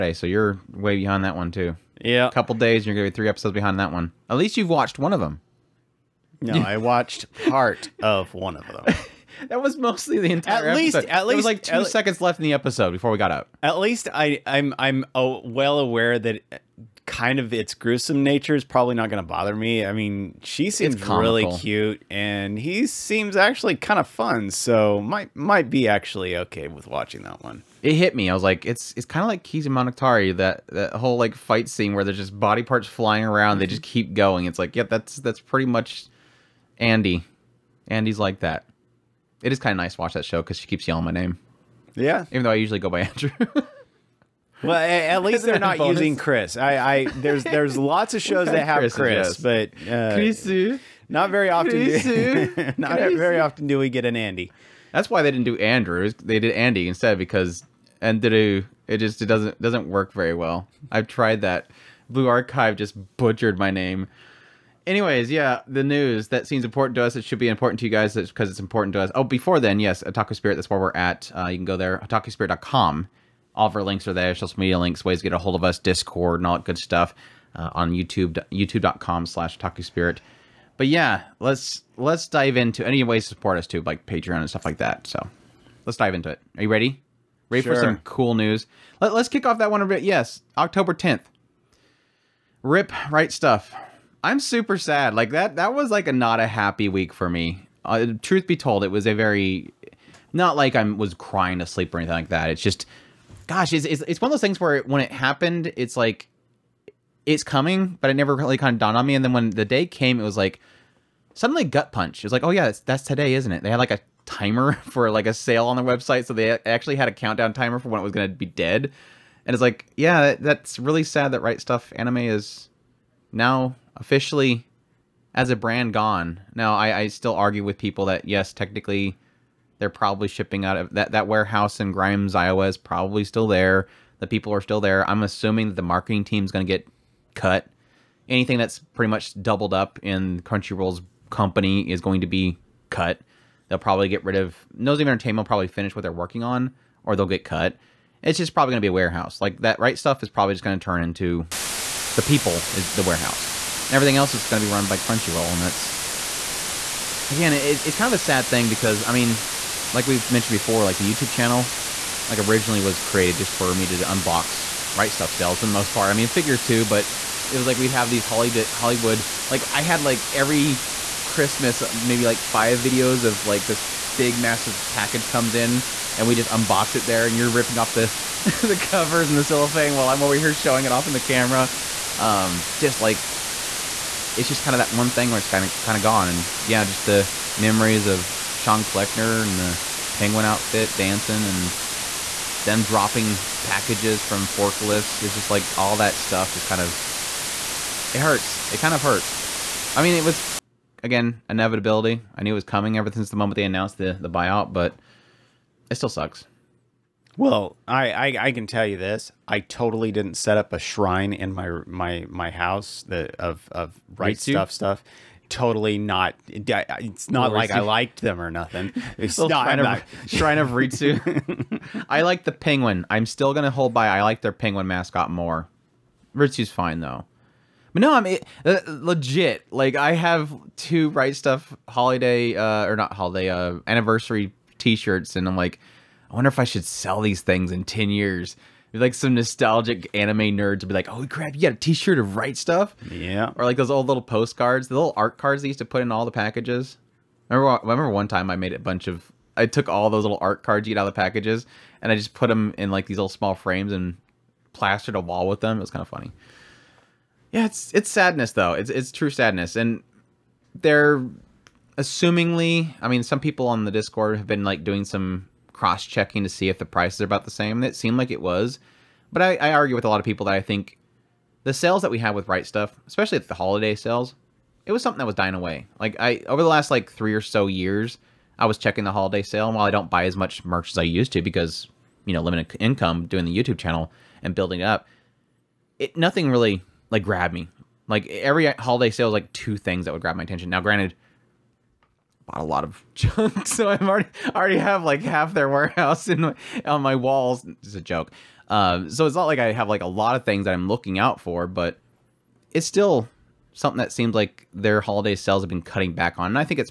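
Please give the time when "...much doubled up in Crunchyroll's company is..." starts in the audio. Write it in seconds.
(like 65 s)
139 s.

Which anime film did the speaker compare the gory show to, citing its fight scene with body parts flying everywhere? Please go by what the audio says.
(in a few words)
Kizu Monogatari.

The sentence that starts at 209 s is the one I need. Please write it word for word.
I totally didn't set up a shrine in my my my house that of of right stuf stuff.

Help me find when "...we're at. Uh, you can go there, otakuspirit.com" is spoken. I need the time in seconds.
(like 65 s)
70 s.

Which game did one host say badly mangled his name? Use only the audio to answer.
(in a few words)
Blue Archive.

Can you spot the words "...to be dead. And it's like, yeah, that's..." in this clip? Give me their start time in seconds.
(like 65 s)
118 s.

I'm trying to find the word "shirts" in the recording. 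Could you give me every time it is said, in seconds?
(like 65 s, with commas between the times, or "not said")
234 s, 241 s.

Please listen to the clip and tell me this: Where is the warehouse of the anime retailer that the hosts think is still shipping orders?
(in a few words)
Grimes, Iowa.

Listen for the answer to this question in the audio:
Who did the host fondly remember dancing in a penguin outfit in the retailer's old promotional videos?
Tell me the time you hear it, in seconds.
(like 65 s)
188 s.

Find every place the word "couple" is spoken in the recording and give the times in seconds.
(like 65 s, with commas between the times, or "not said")
2 s.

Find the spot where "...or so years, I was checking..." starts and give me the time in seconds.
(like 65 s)
277 s.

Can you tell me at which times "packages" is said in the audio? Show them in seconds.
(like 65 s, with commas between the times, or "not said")
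174 s, 193 s, 246 s, 251 s.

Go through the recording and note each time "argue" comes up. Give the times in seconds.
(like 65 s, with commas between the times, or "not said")
127 s, 269 s.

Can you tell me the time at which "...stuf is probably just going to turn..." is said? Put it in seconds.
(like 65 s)
149 s.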